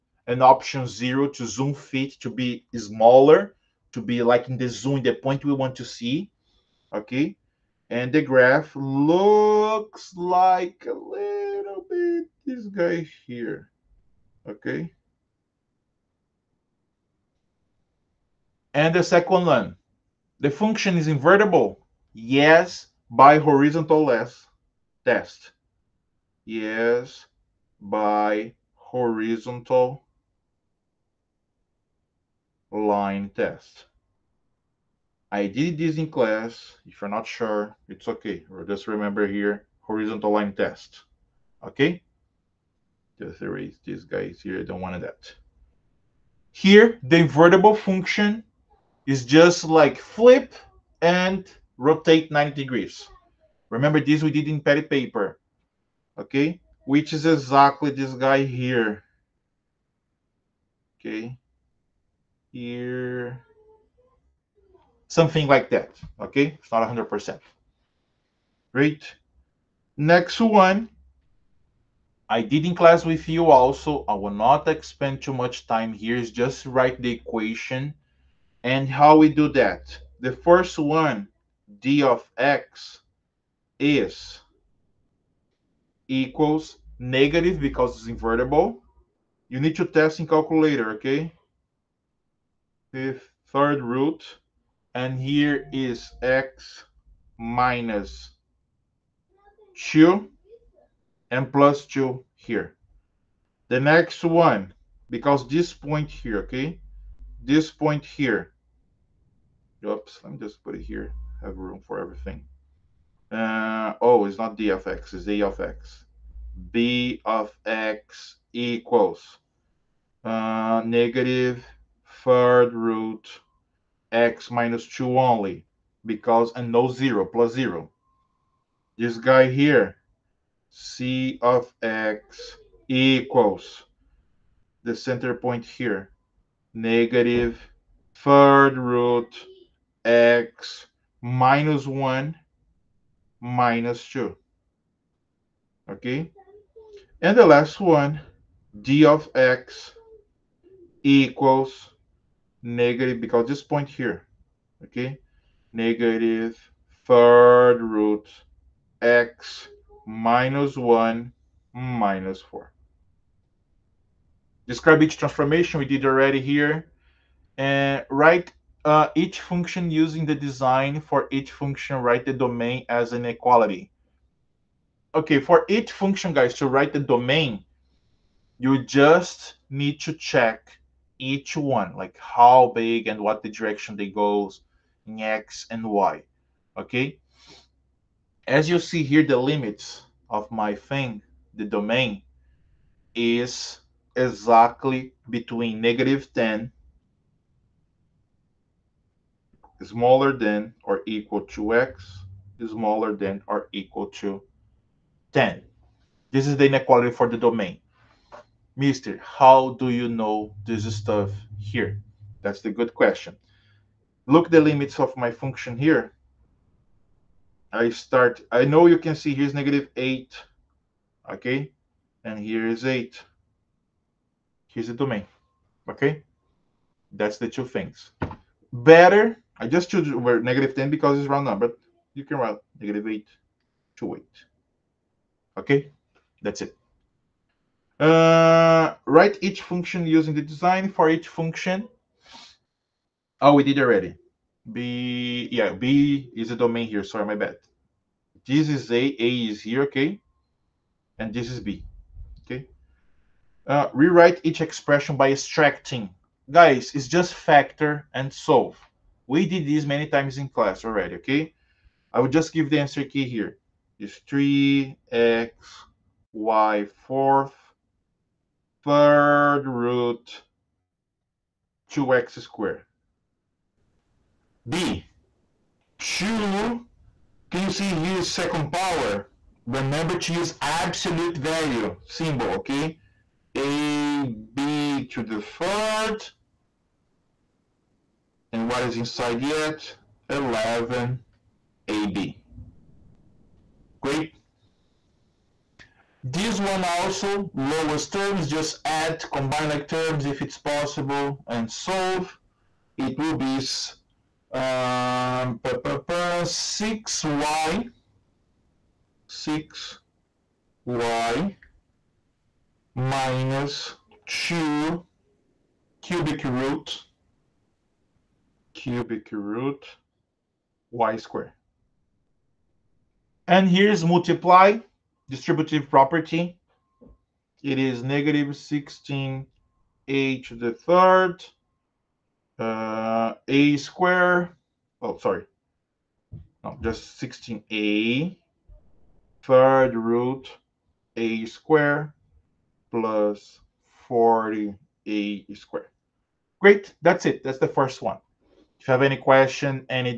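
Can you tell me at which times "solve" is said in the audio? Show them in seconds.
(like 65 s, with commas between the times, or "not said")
258 s, 301 s.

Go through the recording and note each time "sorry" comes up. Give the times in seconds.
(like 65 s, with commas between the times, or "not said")
247 s, 335 s.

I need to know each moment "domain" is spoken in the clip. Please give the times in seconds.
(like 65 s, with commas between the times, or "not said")
172 s, 177 s, 191 s, 207 s, 224 s, 246 s.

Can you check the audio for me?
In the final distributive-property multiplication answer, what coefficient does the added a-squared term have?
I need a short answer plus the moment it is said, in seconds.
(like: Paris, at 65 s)
40, at 344 s.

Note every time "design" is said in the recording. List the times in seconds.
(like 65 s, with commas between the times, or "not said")
170 s, 240 s.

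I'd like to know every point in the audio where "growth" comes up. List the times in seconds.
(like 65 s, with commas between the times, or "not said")
not said.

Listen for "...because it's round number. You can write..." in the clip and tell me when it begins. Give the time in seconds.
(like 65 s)
230 s.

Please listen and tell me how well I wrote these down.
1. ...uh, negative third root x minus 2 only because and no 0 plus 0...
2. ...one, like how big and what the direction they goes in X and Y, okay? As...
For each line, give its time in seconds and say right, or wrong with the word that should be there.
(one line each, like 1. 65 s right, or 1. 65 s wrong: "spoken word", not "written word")
1. 120 s right
2. 181 s right.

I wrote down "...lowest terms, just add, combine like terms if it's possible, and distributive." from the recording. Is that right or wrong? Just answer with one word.
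wrong.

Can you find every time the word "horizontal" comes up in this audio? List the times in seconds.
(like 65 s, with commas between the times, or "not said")
23 s, 28 s, 39 s.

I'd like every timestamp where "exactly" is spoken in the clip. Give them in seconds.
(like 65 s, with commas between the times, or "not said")
57 s, 194 s.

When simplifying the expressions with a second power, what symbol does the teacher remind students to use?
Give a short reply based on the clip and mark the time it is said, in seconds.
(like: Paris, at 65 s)
absolute value symbol, at 280 s.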